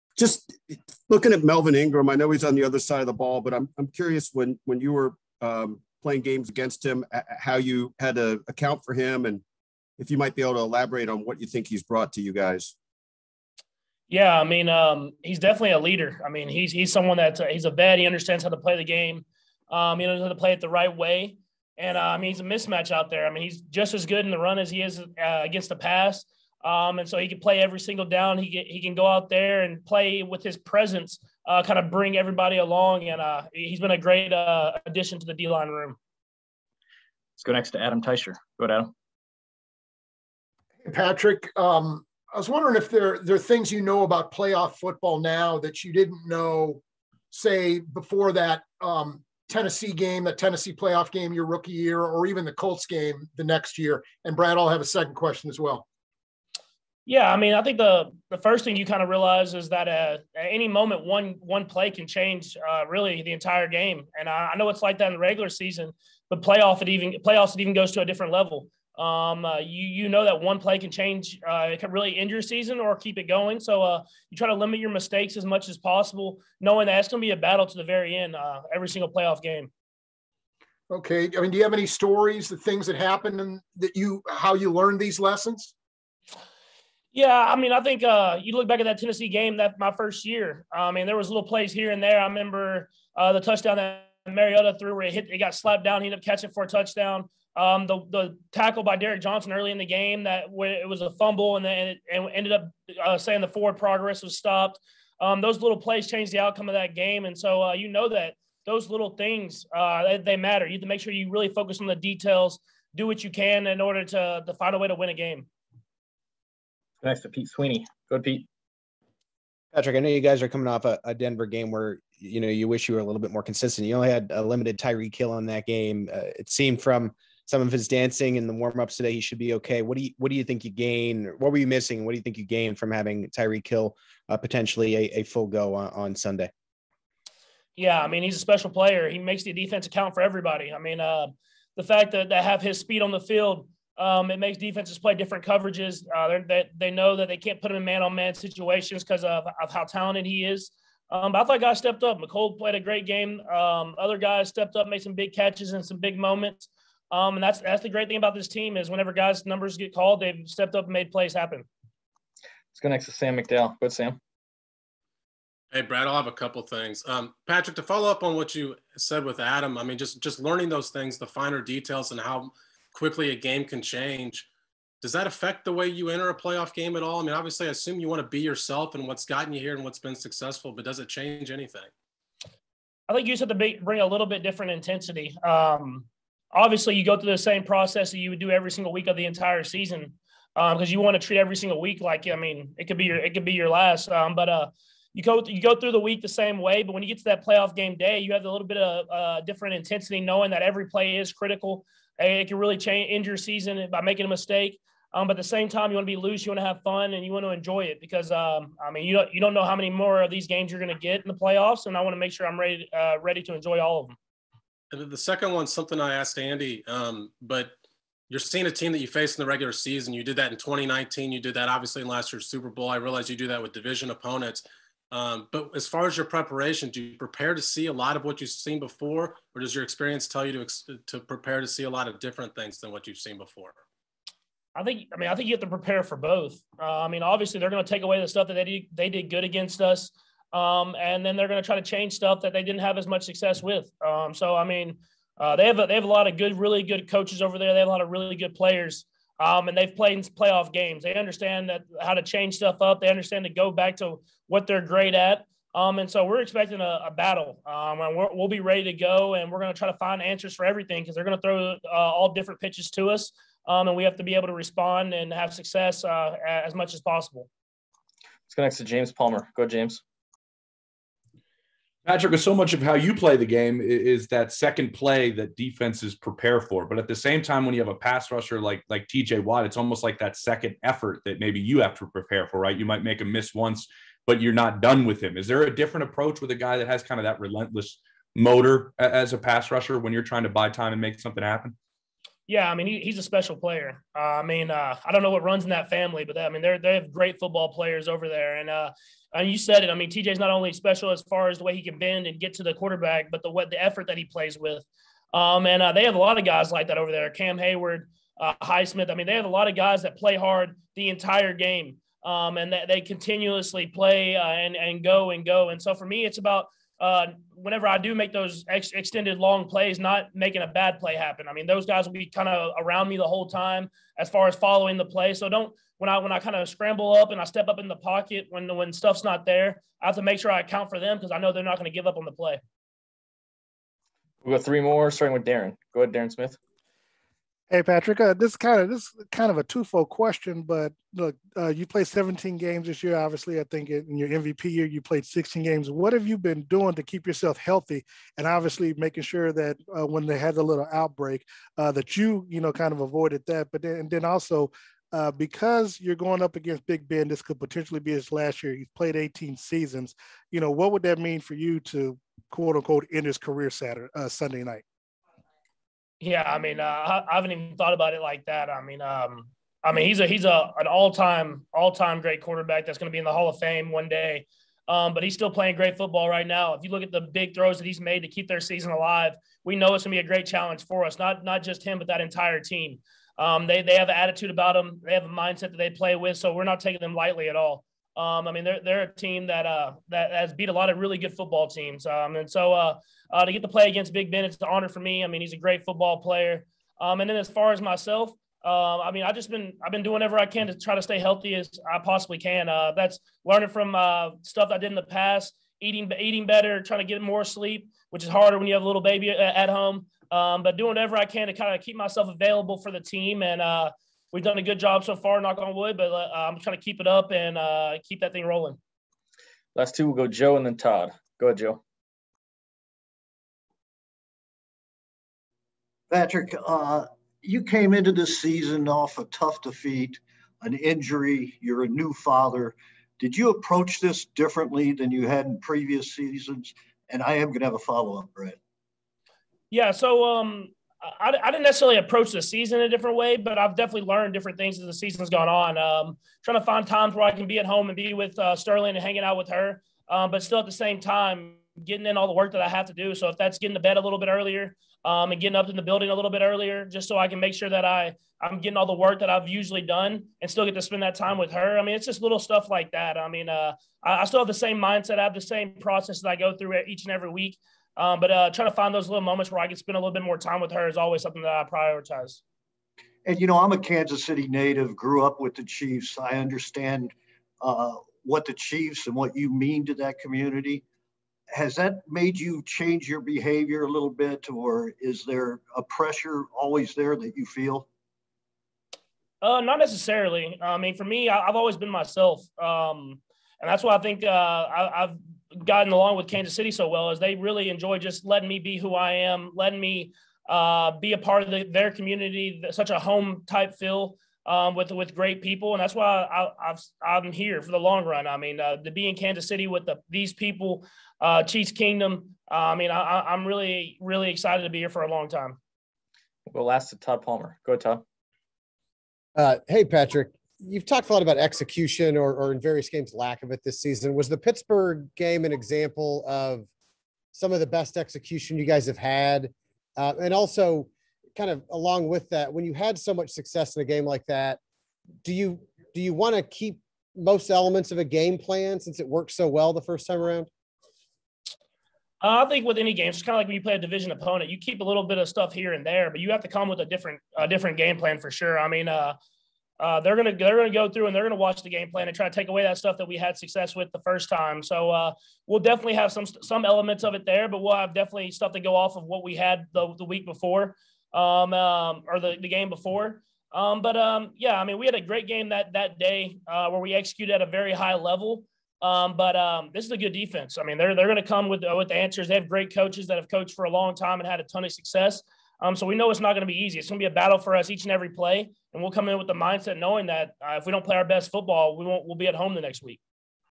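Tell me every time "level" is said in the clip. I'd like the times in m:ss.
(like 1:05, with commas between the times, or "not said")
1:08, 9:27.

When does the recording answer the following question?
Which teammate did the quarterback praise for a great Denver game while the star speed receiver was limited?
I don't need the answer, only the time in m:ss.
2:32.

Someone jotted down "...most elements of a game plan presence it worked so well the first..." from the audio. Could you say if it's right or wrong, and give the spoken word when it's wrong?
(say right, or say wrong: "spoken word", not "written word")
wrong: "since", not "presence".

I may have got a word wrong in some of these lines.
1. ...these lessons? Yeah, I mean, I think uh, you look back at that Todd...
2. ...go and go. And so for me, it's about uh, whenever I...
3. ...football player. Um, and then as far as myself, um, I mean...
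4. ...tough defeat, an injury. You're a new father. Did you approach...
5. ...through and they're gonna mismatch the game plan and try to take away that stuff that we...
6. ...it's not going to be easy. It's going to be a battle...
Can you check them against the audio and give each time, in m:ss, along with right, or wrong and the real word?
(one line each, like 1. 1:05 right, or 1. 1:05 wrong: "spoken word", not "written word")
1. 1:25 wrong: "Tennessee", not "Todd"
2. 5:15 right
3. 6:35 right
4. 7:09 right
5. 9:10 wrong: "watch", not "mismatch"
6. 9:36 right.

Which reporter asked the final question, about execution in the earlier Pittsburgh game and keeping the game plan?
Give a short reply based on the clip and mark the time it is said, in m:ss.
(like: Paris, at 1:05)
Todd Palmer, at 8:36.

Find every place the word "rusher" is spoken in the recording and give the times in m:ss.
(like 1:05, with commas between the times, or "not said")
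4:38, 4:49.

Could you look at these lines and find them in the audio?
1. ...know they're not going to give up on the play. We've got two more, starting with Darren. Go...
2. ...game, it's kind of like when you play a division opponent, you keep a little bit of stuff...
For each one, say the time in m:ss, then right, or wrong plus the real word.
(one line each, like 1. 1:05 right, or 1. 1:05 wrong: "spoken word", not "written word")
1. 5:31 wrong: "three", not "two"
2. 9:02 right.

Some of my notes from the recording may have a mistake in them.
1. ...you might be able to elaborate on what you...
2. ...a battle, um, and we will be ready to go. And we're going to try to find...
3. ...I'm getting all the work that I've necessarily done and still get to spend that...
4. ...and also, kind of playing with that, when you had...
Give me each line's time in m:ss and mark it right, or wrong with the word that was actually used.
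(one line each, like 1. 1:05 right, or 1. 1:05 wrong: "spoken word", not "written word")
1. 0:10 right
2. 4:17 right
3. 7:38 wrong: "usually", not "necessarily"
4. 8:50 wrong: "along", not "playing".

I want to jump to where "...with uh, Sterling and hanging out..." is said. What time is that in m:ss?
7:28.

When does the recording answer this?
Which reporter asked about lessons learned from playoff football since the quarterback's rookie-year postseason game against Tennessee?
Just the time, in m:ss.
0:37.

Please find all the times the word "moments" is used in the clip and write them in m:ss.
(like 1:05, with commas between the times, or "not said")
1:00, 2:36, 7:49.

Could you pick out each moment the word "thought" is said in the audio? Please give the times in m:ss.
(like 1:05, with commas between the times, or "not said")
2:31, 6:07.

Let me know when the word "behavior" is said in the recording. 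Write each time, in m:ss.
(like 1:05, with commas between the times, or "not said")
8:03.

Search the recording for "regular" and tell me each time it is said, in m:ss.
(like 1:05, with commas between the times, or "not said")
1:05, 3:39.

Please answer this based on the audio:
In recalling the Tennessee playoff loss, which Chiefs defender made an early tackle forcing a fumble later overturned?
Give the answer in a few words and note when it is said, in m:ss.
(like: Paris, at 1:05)
Derrick Johnson, at 1:38.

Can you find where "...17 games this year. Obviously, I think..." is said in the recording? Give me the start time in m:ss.
5:42.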